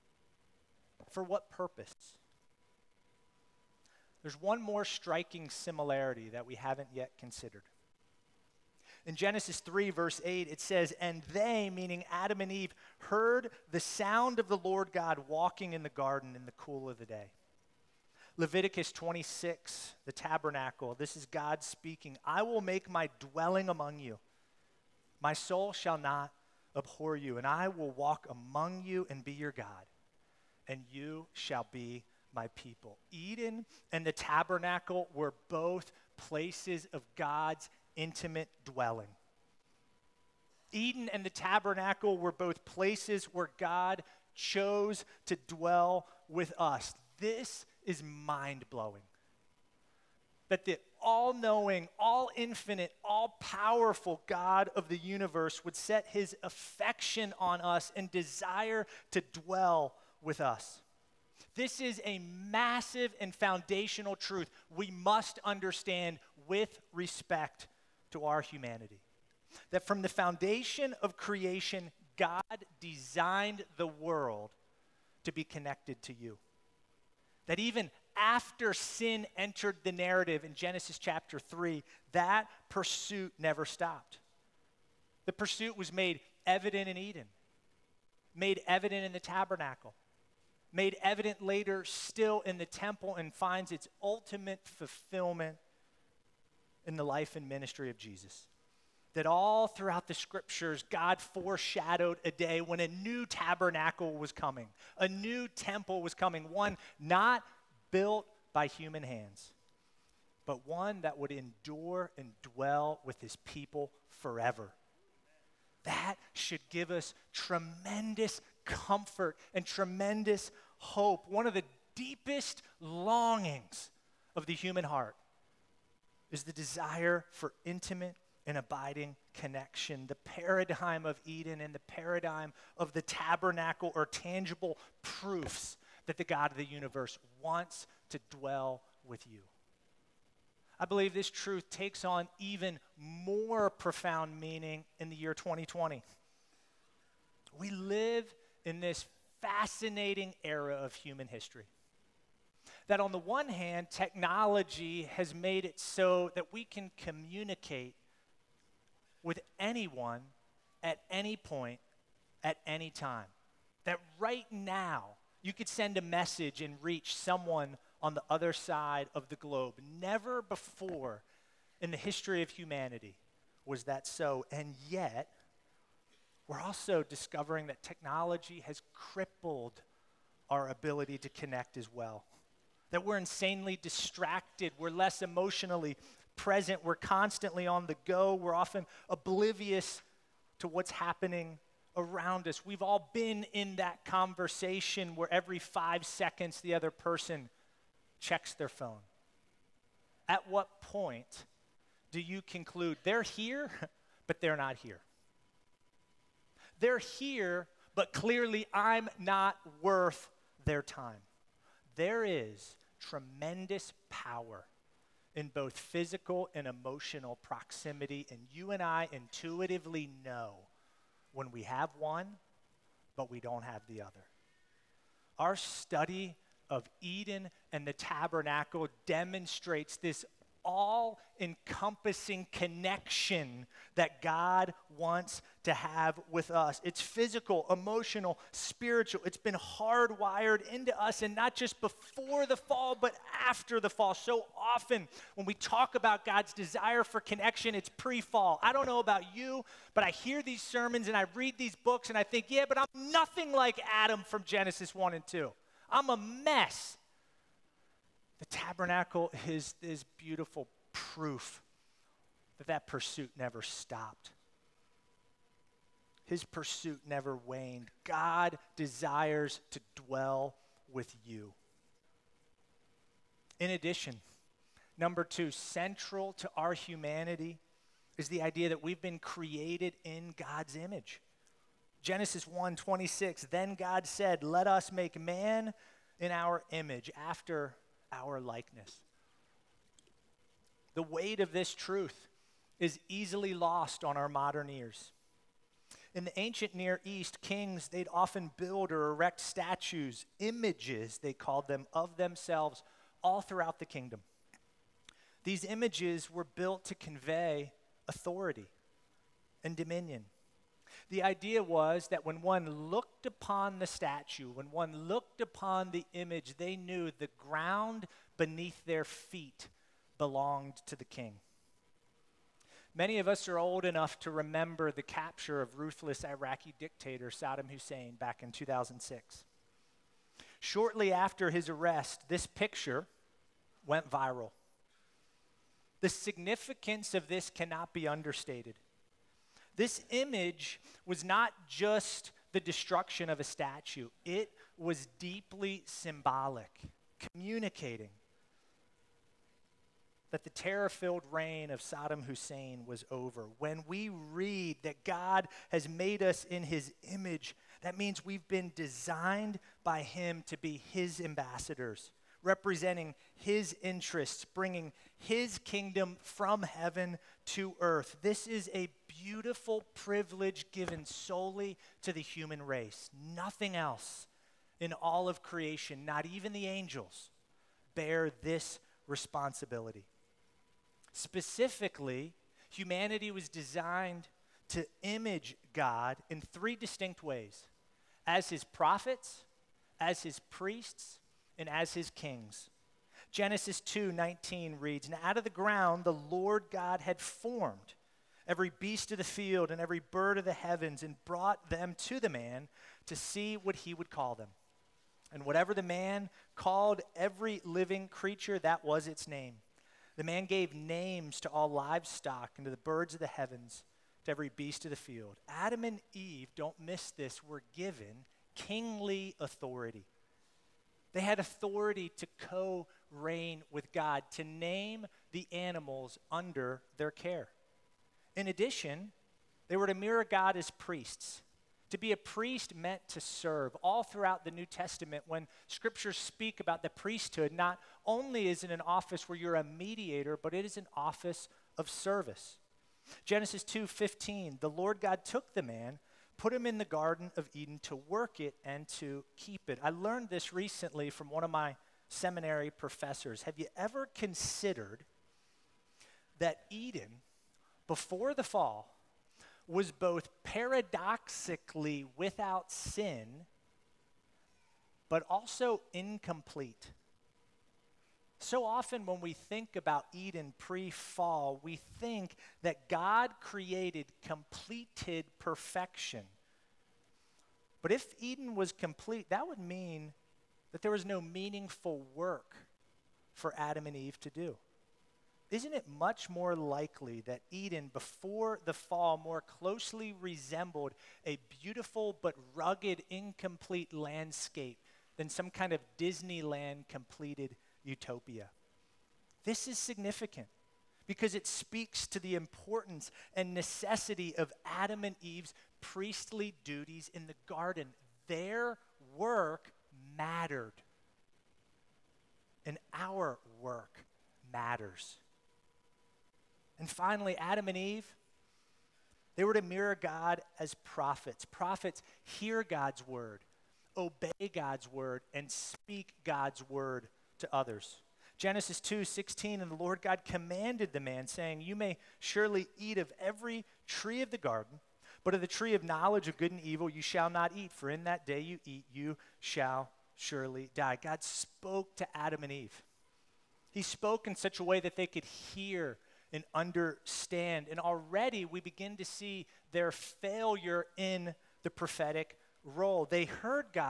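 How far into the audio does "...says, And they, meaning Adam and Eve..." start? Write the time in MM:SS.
00:10.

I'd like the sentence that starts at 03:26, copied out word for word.
They're here, but clearly I'm not worth their time.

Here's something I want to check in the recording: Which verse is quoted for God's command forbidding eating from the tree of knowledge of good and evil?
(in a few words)
Genesis 2:16.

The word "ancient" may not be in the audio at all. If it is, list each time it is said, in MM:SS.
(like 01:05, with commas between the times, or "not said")
04:56.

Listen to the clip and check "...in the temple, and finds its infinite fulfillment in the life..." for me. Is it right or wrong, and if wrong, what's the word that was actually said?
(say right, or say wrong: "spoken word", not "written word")
wrong: "ultimate", not "infinite".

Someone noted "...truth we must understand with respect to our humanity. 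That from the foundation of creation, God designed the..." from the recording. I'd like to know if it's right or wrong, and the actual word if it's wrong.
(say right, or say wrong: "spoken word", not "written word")
right.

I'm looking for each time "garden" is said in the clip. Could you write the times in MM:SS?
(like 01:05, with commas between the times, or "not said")
00:15, 07:26, 08:27, 08:54.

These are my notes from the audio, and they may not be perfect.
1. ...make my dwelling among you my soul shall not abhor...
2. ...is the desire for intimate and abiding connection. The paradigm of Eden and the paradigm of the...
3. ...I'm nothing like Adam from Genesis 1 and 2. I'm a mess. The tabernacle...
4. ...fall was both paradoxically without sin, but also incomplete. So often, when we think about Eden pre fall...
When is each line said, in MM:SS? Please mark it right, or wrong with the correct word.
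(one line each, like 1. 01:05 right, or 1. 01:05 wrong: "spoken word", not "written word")
1. 00:22 right
2. 02:06 right
3. 04:12 right
4. 07:38 right.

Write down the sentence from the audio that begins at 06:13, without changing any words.
Nothing else in all of creation, not even the angels, bear this responsibility.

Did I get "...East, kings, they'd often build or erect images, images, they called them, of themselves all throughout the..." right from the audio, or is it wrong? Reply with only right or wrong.
wrong.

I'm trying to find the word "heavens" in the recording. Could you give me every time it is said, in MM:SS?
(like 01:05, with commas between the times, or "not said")
06:06, 06:40, 06:53.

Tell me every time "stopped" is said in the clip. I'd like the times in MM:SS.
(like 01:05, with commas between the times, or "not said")
01:23, 04:23.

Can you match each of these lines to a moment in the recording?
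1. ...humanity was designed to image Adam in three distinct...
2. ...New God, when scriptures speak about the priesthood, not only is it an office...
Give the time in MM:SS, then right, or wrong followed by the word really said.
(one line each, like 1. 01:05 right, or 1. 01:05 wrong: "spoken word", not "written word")
1. 06:22 wrong: "God", not "Adam"
2. 07:14 wrong: "Testament", not "God".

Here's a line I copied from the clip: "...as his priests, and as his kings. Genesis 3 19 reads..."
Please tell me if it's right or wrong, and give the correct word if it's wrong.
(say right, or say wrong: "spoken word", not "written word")
wrong: "2", not "3".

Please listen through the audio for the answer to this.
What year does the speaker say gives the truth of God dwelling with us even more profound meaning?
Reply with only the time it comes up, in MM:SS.
02:25.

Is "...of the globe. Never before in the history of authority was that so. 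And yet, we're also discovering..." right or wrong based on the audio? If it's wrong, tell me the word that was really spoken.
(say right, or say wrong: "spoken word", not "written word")
wrong: "humanity", not "authority".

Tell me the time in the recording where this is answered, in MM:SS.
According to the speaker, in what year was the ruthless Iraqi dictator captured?
05:28.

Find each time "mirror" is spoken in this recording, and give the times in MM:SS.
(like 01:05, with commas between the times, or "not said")
07:09, 08:39.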